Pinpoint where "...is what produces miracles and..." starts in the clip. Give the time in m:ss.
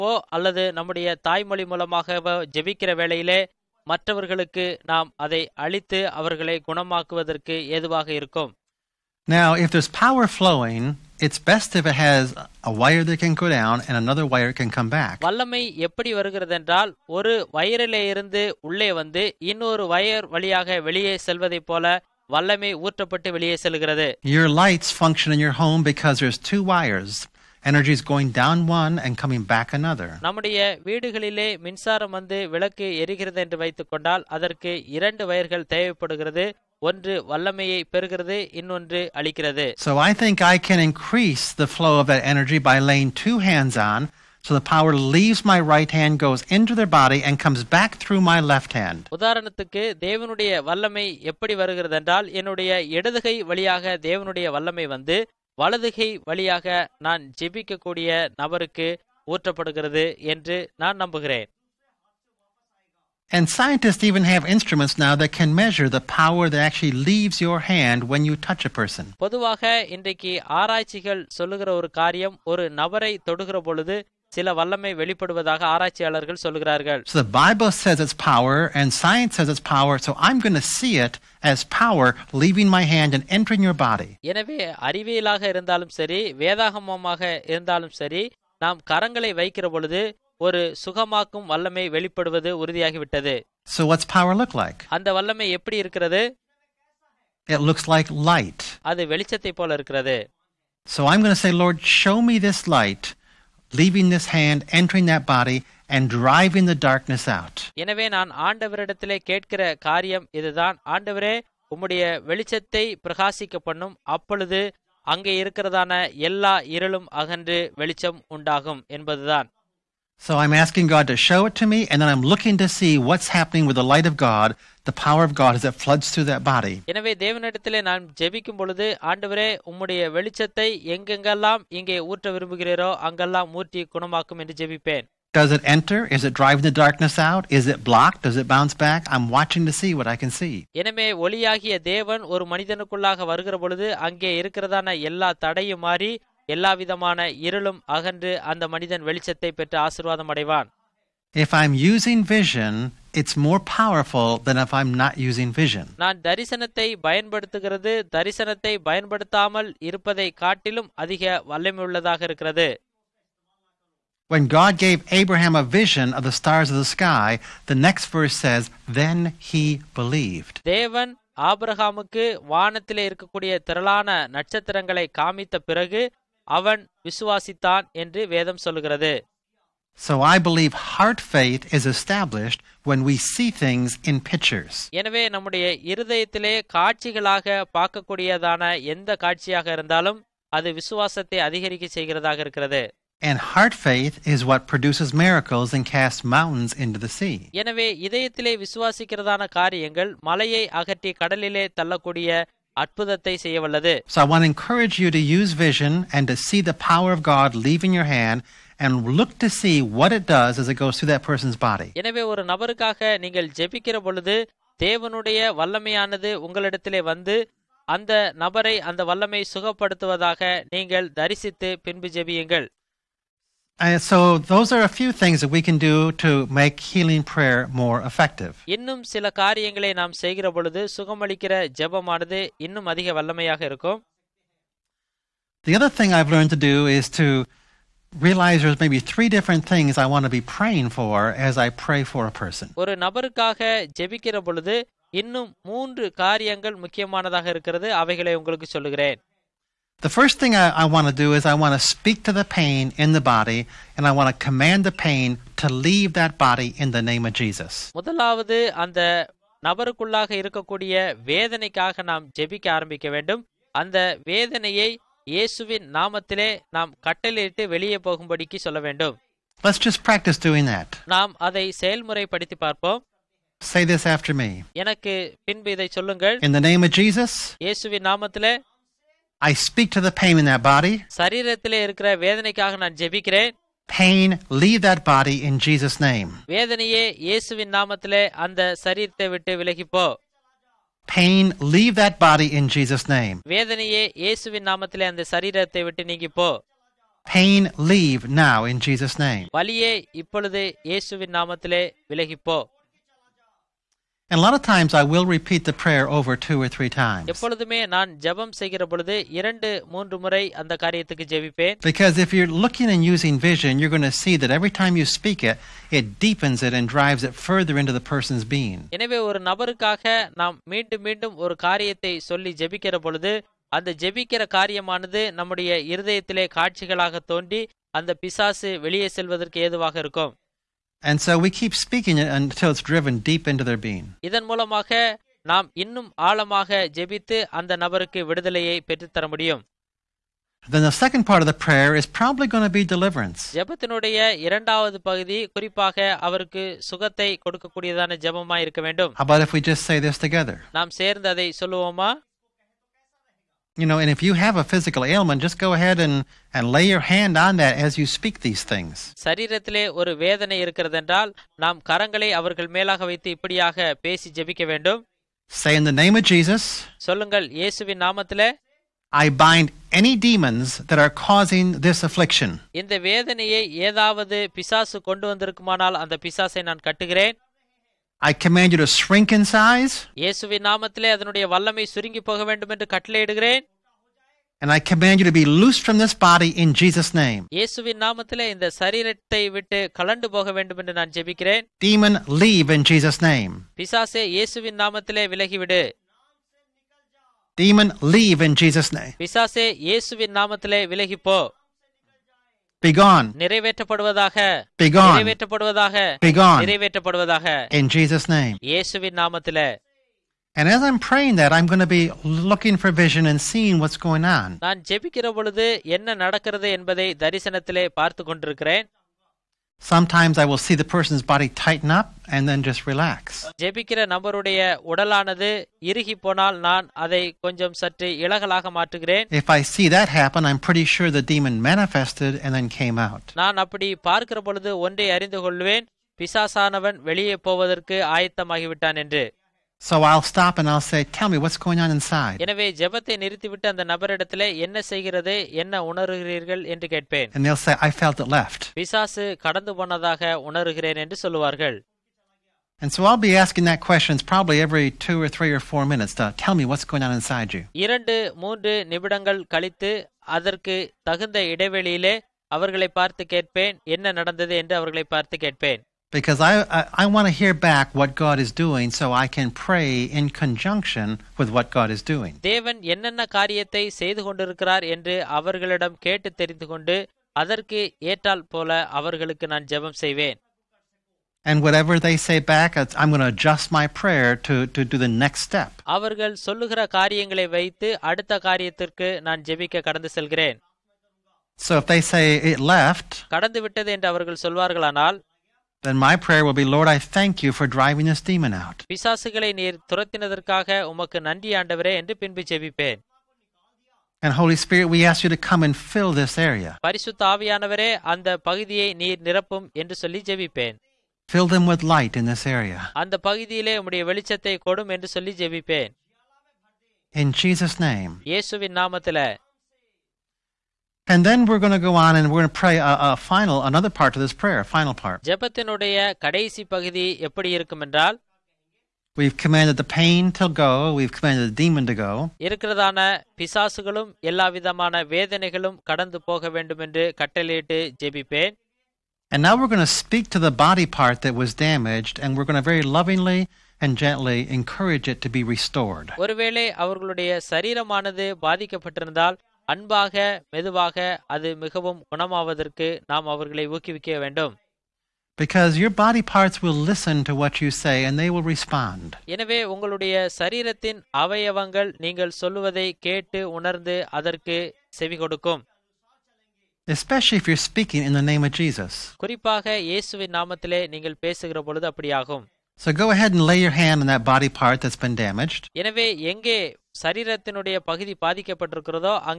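3:14.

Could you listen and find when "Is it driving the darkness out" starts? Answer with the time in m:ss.
2:16.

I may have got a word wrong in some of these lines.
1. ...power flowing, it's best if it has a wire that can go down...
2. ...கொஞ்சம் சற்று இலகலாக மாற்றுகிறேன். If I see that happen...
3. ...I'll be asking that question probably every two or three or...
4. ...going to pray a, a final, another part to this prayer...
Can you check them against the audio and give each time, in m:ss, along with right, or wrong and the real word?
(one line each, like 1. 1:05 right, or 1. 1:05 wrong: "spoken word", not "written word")
1. 0:10 right
2. 7:07 right
3. 7:33 right
4. 8:42 right.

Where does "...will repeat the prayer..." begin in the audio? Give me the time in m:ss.
5:05.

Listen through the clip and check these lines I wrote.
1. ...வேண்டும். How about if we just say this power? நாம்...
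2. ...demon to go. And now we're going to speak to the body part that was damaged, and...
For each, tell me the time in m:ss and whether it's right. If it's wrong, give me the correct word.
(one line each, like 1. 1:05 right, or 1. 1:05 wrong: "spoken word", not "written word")
1. 5:48 wrong: "together", not "power"
2. 8:51 right.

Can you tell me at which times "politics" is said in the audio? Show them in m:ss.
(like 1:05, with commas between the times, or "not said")
not said.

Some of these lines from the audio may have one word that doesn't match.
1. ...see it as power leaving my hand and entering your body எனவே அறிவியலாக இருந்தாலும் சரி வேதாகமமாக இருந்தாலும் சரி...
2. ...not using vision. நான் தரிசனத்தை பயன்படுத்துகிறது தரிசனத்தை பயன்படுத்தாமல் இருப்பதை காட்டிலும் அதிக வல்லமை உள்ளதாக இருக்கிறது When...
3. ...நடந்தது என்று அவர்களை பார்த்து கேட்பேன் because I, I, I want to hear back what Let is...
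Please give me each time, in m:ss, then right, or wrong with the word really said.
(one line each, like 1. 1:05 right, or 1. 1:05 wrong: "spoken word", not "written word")
1. 1:20 right
2. 2:35 right
3. 7:44 wrong: "God", not "Let".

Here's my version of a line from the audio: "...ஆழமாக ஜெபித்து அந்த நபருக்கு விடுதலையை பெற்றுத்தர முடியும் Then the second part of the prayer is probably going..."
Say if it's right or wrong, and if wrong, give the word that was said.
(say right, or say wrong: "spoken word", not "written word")
right.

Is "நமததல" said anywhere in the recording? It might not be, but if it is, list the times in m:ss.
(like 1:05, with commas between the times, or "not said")
4:25, 4:38, 6:08, 6:49, 9:30.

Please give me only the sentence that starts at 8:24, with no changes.
And Holy Spirit, we ask you to come and fill this area.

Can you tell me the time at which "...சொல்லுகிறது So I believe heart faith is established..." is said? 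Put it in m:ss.
2:58.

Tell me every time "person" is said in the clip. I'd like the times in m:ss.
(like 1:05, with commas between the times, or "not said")
1:08, 3:31, 4:02, 5:18, 7:00.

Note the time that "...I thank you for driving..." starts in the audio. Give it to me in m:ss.
8:16.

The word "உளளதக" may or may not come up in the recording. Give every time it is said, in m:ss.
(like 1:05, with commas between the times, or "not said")
2:41.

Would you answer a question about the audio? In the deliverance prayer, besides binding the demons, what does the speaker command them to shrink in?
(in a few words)
Size.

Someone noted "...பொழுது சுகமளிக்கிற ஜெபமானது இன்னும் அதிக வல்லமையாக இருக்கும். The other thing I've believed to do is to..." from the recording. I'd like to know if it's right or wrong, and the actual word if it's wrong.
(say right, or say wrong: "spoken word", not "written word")
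wrong: "learned", not "believed".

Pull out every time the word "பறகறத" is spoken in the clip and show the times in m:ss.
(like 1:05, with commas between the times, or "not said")
0:37.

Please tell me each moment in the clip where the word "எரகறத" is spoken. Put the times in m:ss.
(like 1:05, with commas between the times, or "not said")
0:33.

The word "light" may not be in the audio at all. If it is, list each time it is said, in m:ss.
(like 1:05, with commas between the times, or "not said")
0:24, 1:38, 1:42, 2:03, 8:31.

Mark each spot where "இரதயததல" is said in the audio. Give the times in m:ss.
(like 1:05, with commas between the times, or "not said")
3:05, 5:25.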